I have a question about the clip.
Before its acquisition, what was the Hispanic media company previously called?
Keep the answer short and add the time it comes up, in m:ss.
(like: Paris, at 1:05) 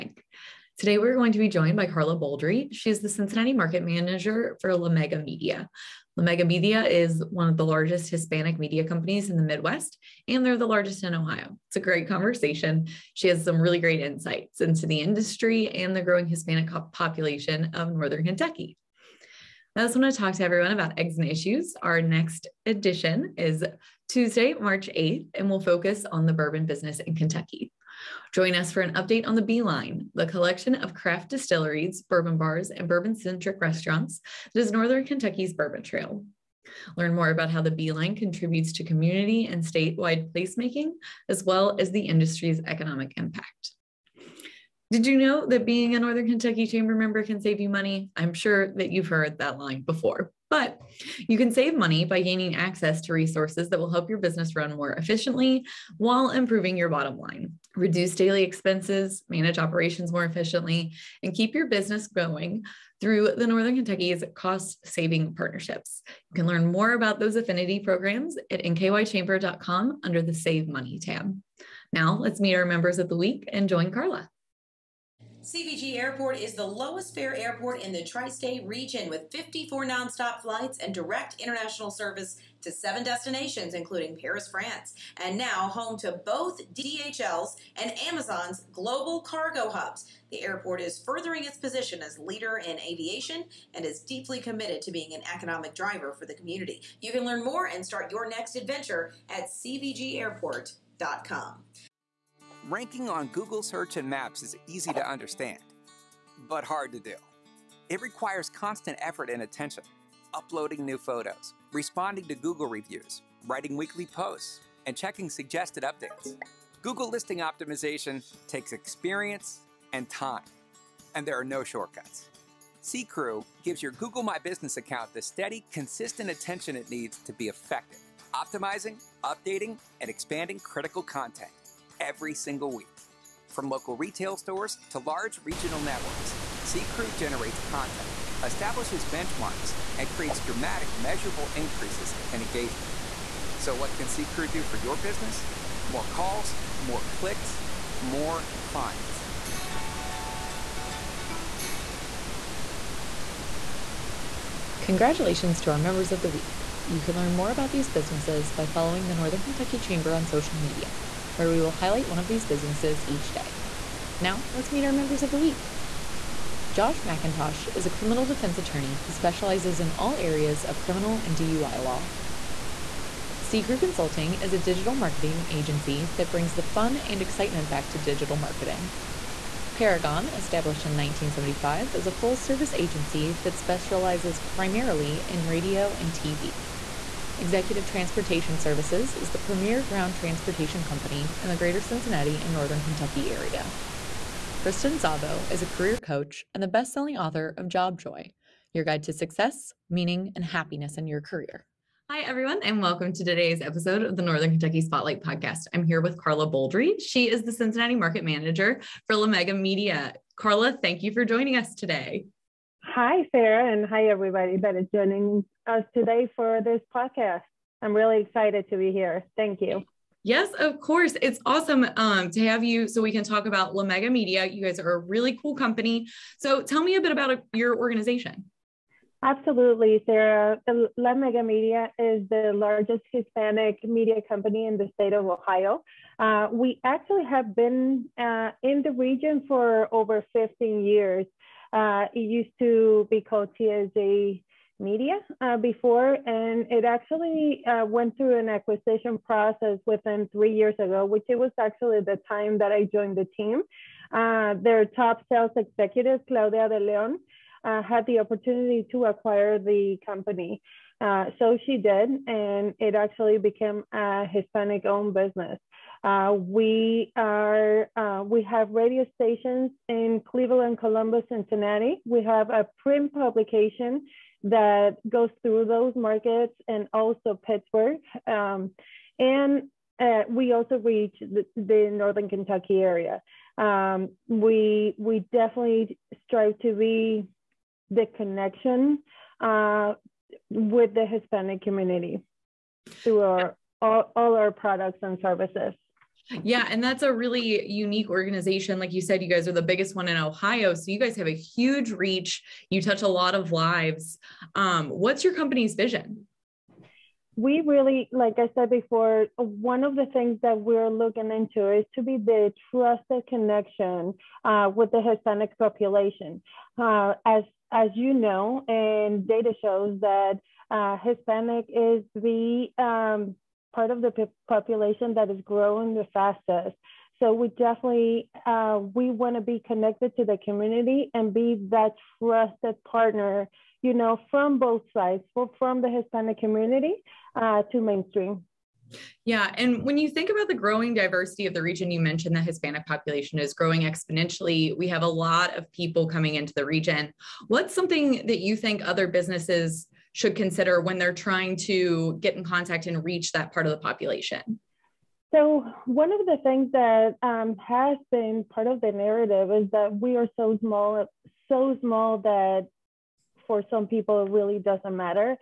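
TSA Media, at 4:03.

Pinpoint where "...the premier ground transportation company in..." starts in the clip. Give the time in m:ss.
3:09.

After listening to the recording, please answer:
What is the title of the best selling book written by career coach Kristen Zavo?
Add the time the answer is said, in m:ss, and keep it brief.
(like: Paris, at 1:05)
Job Joy, at 3:17.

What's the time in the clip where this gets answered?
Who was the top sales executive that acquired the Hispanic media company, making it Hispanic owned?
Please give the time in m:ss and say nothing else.
4:16.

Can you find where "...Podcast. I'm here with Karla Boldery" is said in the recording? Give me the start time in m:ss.
3:25.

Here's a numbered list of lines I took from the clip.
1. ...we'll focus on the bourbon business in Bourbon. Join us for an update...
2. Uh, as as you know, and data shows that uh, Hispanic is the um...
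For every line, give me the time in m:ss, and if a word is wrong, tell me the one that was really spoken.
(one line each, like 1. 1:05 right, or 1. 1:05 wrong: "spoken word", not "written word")
1. 0:25 wrong: "Kentucky", not "Bourbon"
2. 5:16 right.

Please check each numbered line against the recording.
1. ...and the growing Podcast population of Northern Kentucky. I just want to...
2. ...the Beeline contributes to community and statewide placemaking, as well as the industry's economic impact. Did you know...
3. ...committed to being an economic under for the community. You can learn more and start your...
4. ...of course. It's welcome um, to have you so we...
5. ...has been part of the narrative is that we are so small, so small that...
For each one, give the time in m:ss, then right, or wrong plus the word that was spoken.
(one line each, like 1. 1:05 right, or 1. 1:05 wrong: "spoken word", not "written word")
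1. 0:15 wrong: "Hispanic", not "Podcast"
2. 0:37 right
3. 1:34 wrong: "driver", not "under"
4. 3:40 wrong: "awesome", not "welcome"
5. 5:57 right.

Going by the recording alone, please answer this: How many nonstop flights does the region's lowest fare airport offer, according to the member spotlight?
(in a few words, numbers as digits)
54.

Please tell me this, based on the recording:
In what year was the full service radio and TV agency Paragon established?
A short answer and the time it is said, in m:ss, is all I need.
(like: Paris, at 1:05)
1975, at 3:00.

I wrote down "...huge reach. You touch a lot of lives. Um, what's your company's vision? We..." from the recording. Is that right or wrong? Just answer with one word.
right.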